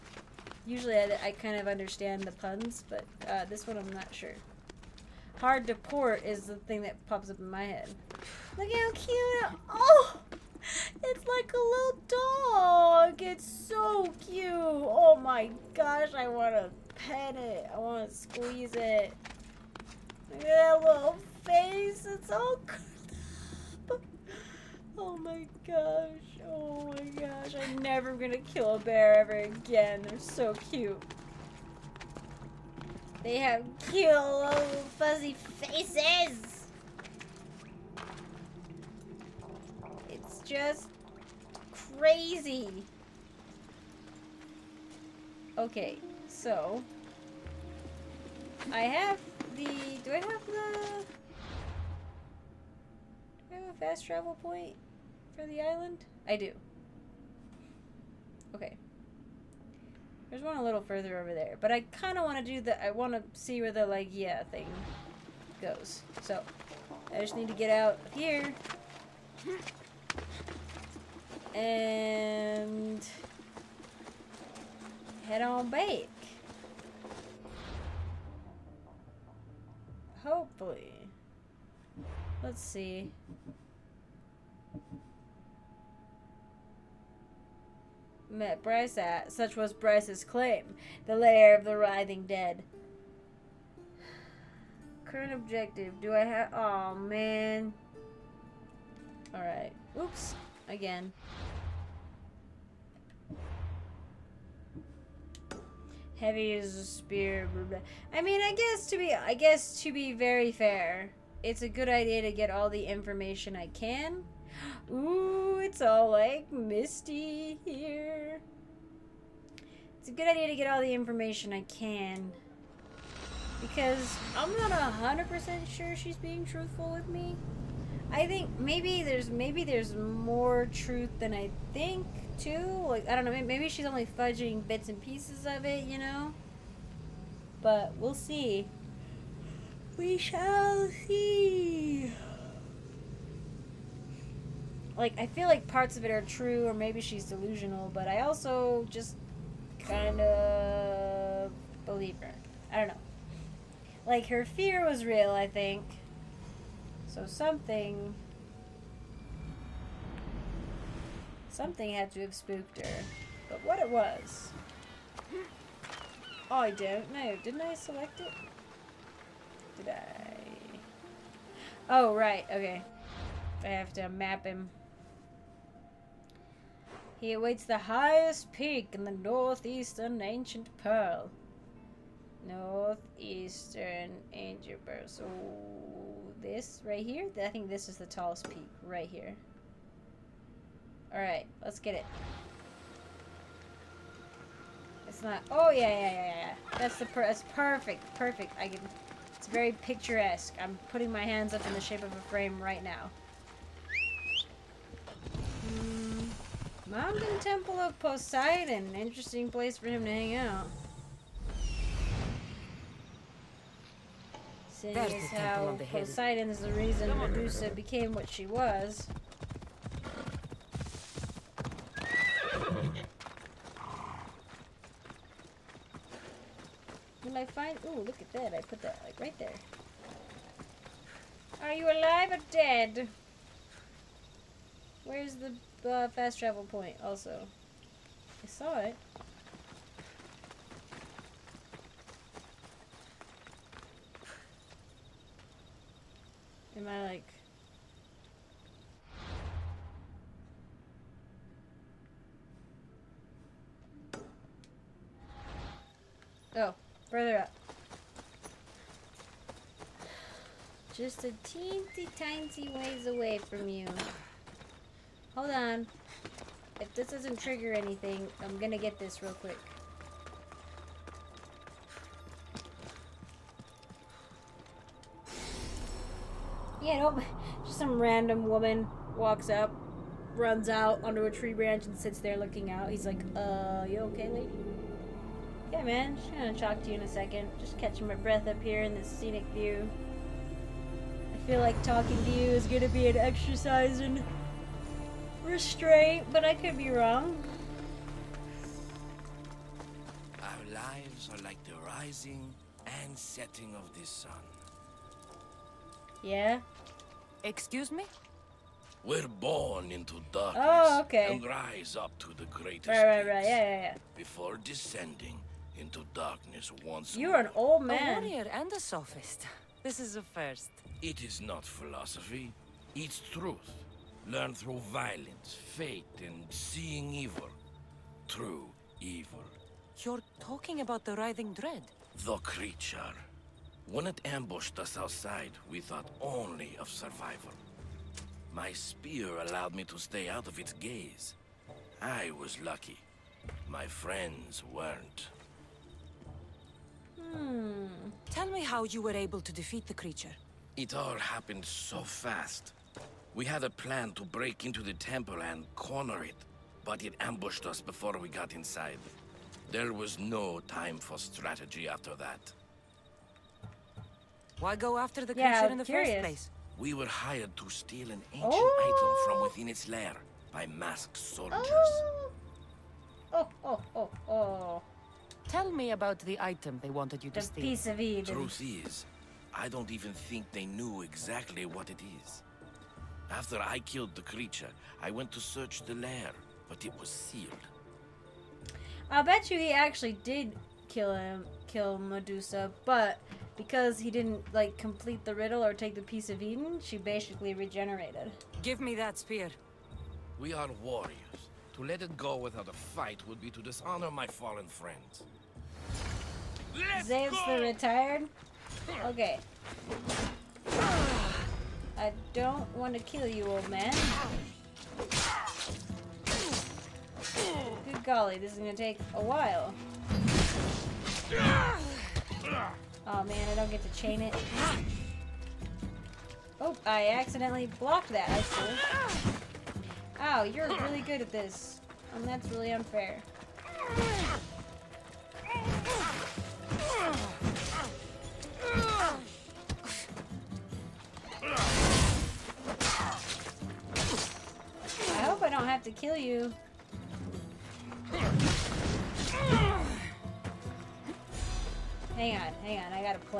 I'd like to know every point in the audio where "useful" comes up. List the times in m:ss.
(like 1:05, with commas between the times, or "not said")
not said.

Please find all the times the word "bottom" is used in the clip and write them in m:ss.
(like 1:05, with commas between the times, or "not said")
not said.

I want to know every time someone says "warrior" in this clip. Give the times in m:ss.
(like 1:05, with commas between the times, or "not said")
5:18, 6:40.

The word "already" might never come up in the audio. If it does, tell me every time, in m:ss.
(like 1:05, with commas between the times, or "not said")
not said.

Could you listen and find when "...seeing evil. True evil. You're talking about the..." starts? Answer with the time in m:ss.
5:26.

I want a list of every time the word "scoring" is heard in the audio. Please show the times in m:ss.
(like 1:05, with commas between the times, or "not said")
not said.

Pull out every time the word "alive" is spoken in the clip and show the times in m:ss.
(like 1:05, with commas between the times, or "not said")
3:51.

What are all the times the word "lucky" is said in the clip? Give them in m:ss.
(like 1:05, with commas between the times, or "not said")
5:42.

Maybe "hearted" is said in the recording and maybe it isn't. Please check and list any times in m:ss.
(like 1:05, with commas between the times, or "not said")
not said.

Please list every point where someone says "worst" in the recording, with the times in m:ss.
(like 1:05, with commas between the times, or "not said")
not said.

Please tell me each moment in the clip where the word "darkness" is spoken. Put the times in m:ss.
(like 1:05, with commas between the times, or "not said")
5:10, 5:16.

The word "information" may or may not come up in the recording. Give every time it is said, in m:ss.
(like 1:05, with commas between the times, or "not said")
1:52, 2:00.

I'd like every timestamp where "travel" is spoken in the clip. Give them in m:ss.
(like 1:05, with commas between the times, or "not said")
0:54, 3:56.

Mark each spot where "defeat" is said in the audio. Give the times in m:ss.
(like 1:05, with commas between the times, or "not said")
5:49.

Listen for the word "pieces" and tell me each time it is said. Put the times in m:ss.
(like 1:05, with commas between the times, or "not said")
2:14, 6:17, 6:36.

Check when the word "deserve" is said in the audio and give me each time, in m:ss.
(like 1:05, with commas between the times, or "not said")
not said.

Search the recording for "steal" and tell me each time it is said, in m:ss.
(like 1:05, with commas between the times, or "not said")
6:07, 6:17.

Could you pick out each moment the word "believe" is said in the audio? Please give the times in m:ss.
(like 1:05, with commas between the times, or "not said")
2:31.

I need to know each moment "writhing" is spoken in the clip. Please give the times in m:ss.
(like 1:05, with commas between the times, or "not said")
1:31, 5:31.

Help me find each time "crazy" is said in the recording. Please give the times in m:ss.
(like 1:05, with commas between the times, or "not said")
0:41.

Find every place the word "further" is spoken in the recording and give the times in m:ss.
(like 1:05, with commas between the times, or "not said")
1:00, 4:17.